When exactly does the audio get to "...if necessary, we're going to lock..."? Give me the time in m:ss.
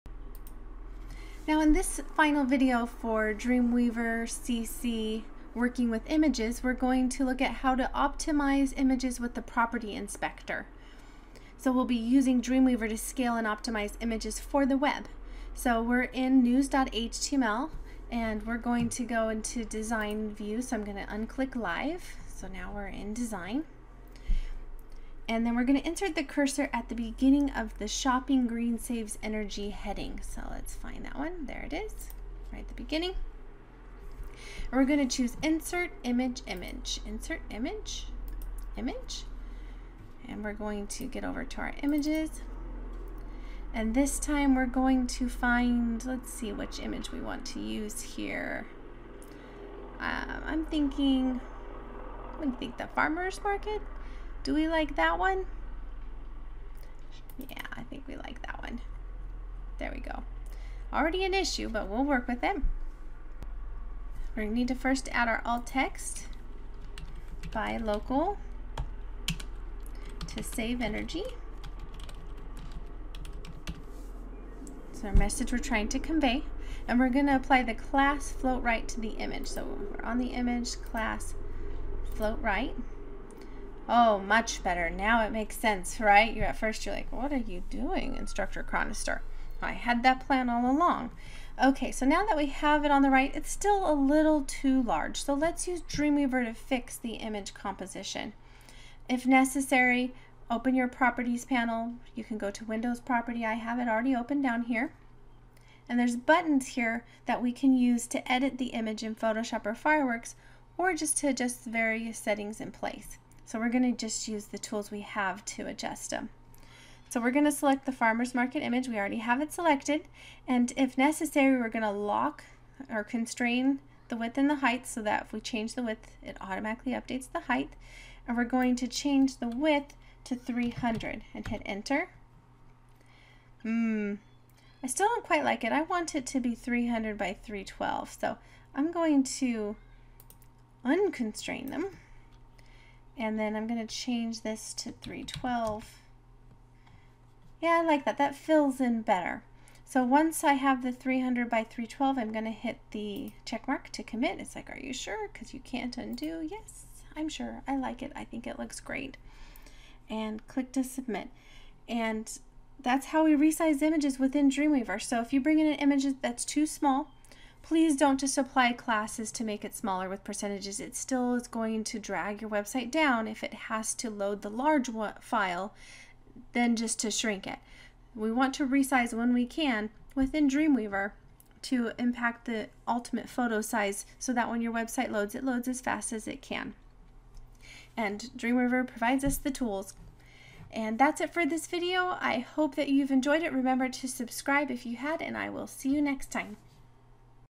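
2:00.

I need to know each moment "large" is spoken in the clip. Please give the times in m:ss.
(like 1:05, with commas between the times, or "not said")
1:34, 2:54.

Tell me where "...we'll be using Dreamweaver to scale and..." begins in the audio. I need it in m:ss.
0:11.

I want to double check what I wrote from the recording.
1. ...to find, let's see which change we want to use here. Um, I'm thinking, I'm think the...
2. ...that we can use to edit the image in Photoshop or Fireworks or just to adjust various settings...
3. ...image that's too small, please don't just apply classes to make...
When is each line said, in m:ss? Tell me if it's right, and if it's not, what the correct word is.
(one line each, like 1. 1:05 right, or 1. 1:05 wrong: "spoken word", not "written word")
1. 0:45 wrong: "image", not "change"
2. 1:47 right
3. 2:45 right.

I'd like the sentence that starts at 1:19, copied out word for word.
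So we're on the image class float right.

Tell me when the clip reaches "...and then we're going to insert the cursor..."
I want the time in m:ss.
0:25.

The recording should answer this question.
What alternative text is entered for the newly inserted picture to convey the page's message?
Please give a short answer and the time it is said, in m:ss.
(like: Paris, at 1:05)
buy local to save energy, at 1:07.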